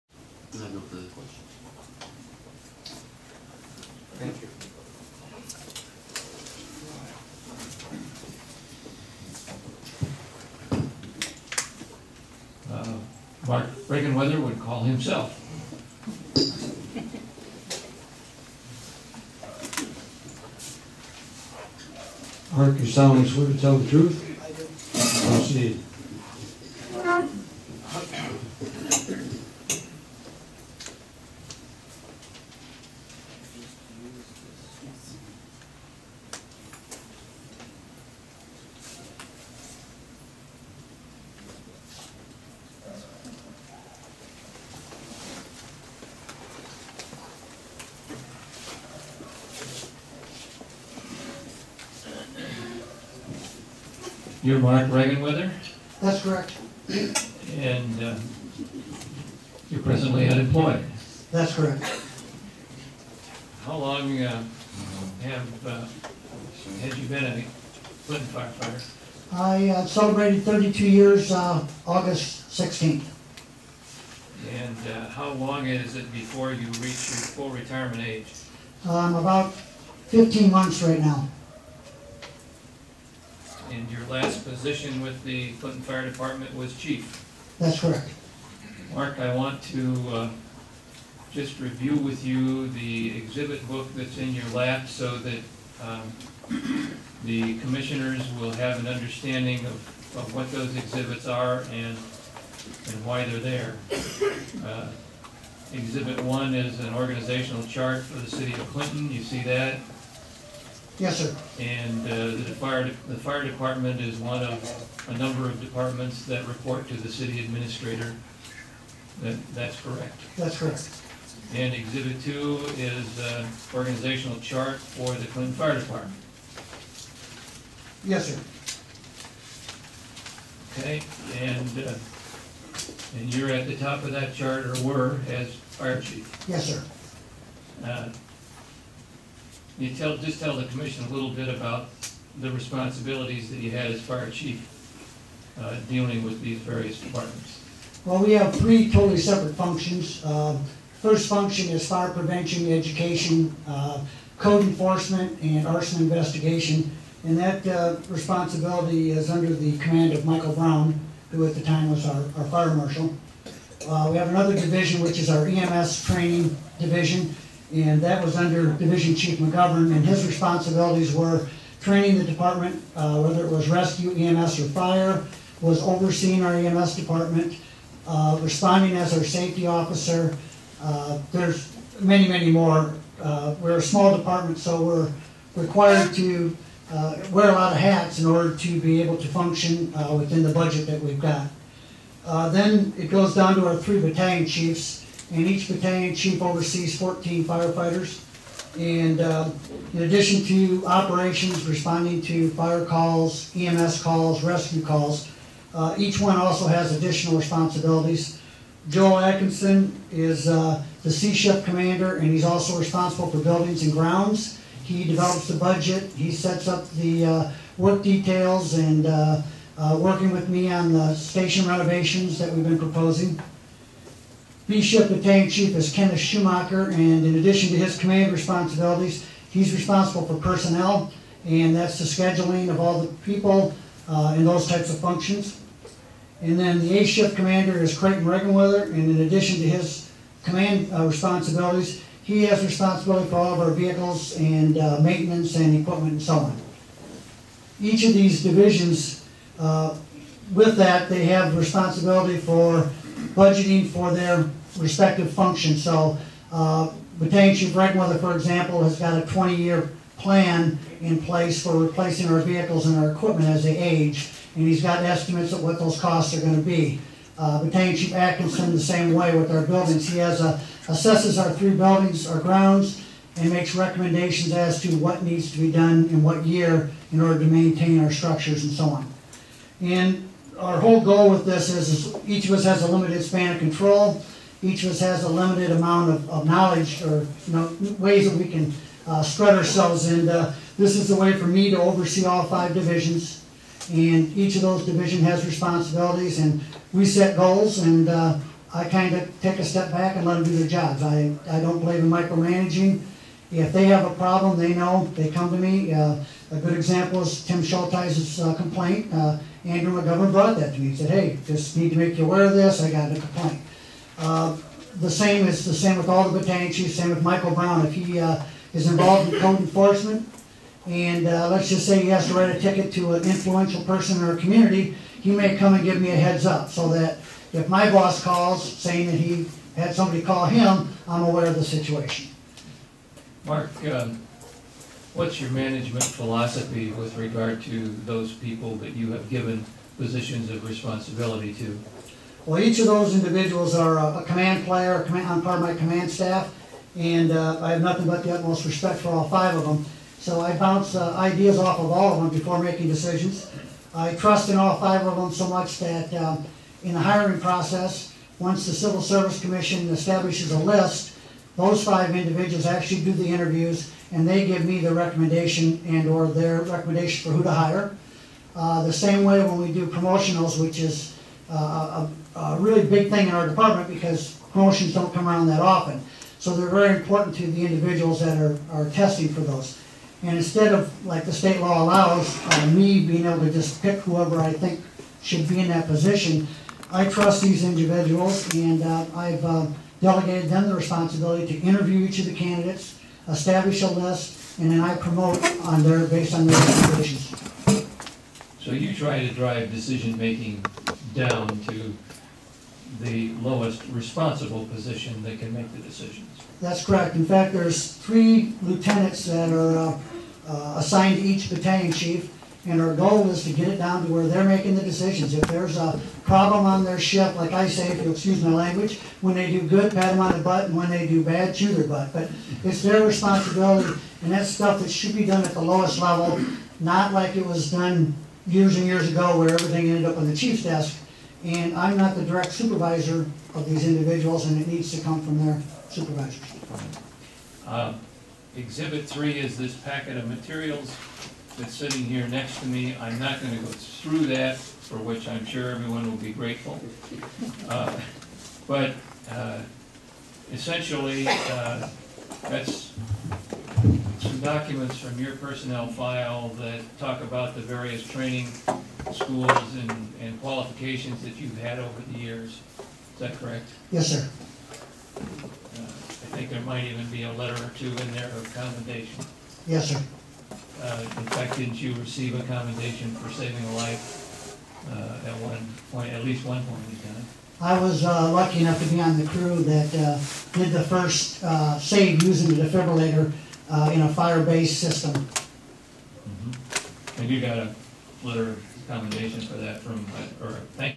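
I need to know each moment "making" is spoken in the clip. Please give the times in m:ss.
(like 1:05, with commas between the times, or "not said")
5:52, 6:39, 6:54.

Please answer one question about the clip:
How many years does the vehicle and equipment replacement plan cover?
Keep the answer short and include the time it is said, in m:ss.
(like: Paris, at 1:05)
20, at 4:19.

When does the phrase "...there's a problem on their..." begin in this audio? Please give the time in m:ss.
6:55.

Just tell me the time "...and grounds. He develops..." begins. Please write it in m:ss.
3:33.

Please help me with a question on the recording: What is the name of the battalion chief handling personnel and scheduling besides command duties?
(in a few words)
Kenneth Schumacher.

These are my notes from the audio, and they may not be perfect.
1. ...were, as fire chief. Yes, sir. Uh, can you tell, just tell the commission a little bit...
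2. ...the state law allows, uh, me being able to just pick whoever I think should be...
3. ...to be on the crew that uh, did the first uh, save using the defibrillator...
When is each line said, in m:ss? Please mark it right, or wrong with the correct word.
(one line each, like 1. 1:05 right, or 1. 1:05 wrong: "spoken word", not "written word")
1. 2:14 right
2. 6:21 right
3. 7:58 right.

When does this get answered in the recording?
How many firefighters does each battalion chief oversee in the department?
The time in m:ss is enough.
3:16.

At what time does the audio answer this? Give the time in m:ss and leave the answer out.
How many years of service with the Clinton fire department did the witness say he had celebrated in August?
1:10.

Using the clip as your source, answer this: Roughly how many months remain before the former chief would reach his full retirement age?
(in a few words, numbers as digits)
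15 months.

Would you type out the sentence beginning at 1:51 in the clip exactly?
And uh, the fire, the fire department is one of a number of departments that report to the city administrator.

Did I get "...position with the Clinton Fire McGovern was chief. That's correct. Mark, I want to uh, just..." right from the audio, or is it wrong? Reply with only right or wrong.
wrong.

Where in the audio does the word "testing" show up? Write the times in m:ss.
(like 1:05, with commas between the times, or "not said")
6:18.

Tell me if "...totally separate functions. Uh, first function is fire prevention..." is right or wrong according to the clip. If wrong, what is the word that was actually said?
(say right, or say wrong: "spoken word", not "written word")
right.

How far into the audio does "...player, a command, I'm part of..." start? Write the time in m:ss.
5:44.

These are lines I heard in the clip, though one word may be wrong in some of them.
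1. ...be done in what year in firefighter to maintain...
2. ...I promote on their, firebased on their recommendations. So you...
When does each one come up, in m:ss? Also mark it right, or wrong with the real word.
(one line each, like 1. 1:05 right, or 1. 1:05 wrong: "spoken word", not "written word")
1. 4:35 wrong: "order", not "firefighter"
2. 6:34 wrong: "based", not "firebased".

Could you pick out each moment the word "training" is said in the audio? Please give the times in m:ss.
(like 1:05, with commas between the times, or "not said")
2:46, 2:51, 7:38.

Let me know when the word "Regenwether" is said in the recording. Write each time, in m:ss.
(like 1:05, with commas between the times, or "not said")
0:13, 0:54, 3:58, 4:17.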